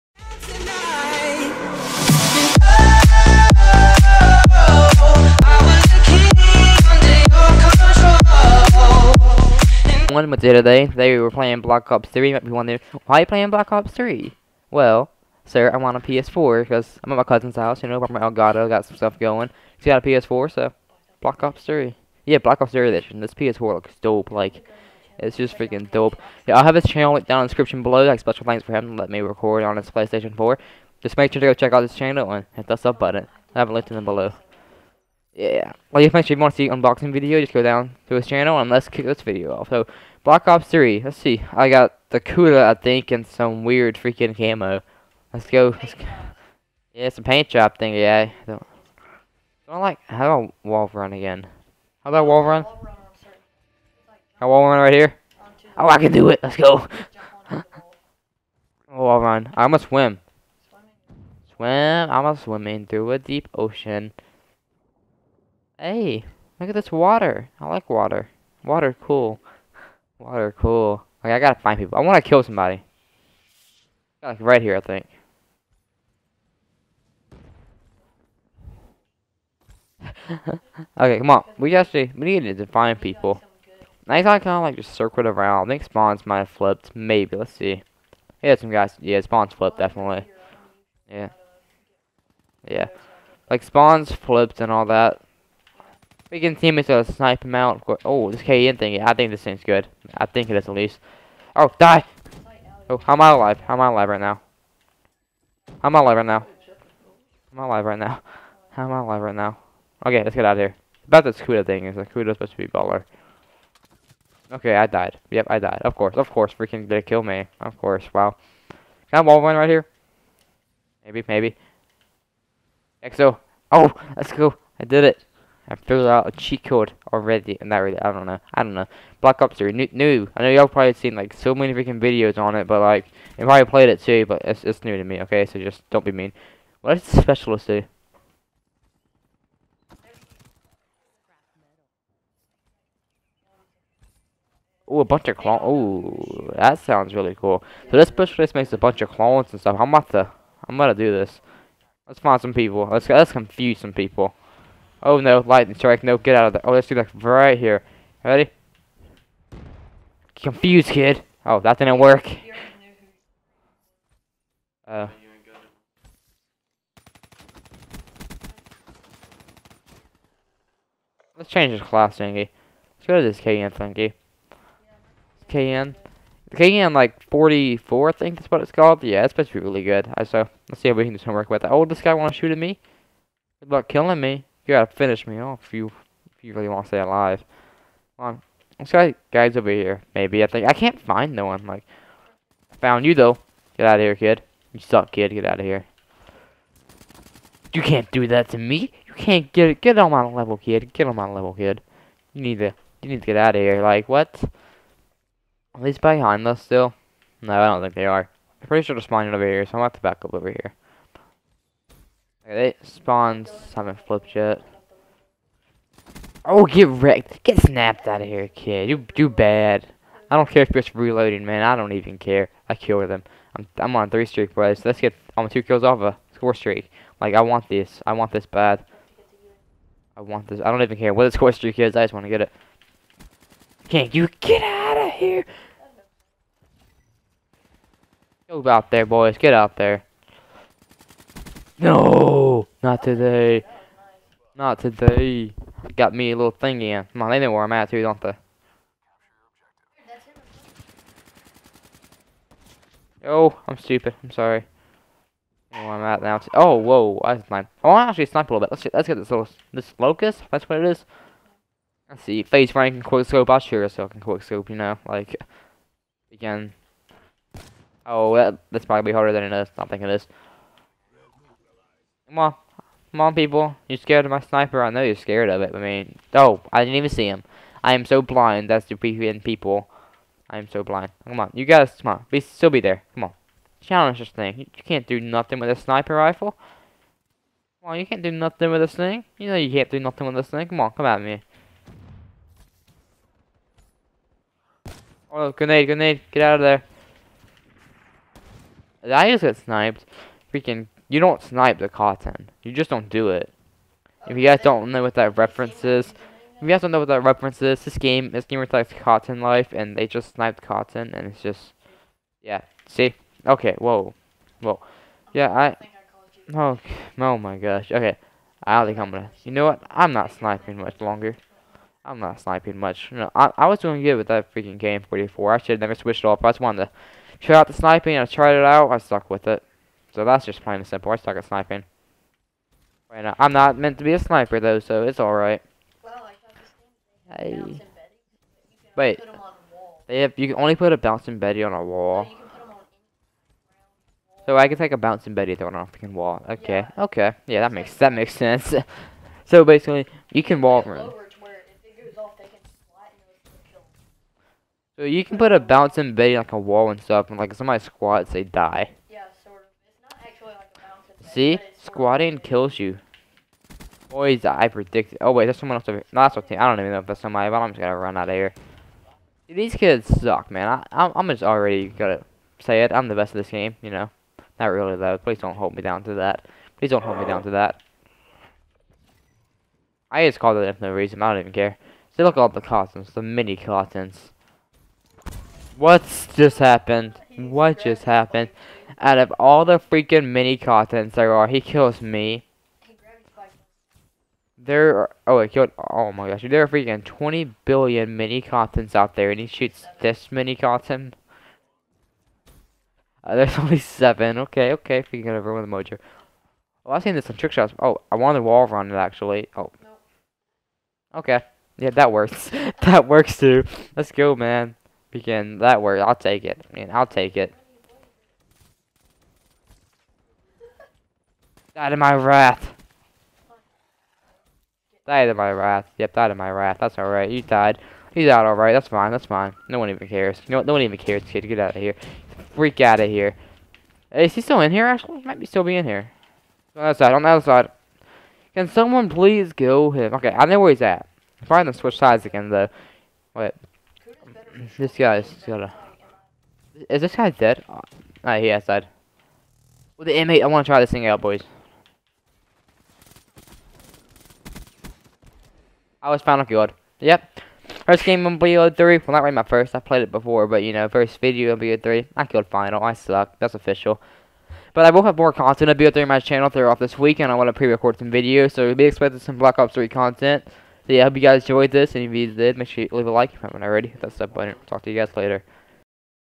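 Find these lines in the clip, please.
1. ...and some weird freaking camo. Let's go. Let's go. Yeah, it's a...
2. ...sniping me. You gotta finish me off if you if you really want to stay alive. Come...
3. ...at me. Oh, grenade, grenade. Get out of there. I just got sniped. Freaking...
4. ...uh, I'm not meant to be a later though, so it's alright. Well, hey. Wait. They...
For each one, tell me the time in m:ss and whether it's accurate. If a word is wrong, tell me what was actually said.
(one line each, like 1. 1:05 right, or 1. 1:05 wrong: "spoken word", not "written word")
1. 0:43 right
2. 3:03 wrong: "killing", not "sniping"
3. 4:51 right
4. 5:33 wrong: "sniper", not "later".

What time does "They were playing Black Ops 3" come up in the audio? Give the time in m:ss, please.
0:10.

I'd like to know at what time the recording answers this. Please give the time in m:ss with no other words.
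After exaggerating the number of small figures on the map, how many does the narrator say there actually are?
6:43.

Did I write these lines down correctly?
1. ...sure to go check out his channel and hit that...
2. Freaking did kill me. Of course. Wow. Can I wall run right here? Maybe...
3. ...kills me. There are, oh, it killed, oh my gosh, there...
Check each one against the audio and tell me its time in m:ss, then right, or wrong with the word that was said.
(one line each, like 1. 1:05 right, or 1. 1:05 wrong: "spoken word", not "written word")
1. 0:31 right
2. 1:56 right
3. 6:31 right.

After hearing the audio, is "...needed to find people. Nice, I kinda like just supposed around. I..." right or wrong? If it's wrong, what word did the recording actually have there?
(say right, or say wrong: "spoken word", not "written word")
wrong: "circled", not "supposed".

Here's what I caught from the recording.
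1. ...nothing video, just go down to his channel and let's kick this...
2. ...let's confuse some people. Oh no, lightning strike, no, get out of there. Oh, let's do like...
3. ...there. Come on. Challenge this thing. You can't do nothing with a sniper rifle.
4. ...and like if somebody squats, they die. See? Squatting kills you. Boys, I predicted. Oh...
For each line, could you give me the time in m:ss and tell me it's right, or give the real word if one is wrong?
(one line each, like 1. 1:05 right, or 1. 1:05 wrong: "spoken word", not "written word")
1. 0:36 wrong: "unboxing", not "nothing"
2. 2:33 right
3. 4:42 right
4. 5:57 right.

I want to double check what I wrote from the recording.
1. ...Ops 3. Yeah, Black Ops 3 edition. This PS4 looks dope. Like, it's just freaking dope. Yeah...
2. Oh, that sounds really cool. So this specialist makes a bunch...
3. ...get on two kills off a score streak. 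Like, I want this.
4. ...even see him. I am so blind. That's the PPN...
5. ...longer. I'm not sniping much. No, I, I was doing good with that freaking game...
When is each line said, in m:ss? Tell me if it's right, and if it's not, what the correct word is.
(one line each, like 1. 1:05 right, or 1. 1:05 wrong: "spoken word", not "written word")
1. 0:21 right
2. 2:25 right
3. 3:45 right
4. 4:36 right
5. 5:21 right.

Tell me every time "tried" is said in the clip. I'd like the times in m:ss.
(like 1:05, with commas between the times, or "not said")
5:28.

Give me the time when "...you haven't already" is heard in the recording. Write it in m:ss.
7:53.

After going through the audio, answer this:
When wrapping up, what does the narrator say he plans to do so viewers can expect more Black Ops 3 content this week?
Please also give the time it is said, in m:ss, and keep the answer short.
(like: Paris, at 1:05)
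Pre-record some videos, at 7:47.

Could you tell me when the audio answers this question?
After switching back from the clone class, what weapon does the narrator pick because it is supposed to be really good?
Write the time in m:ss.
2:56.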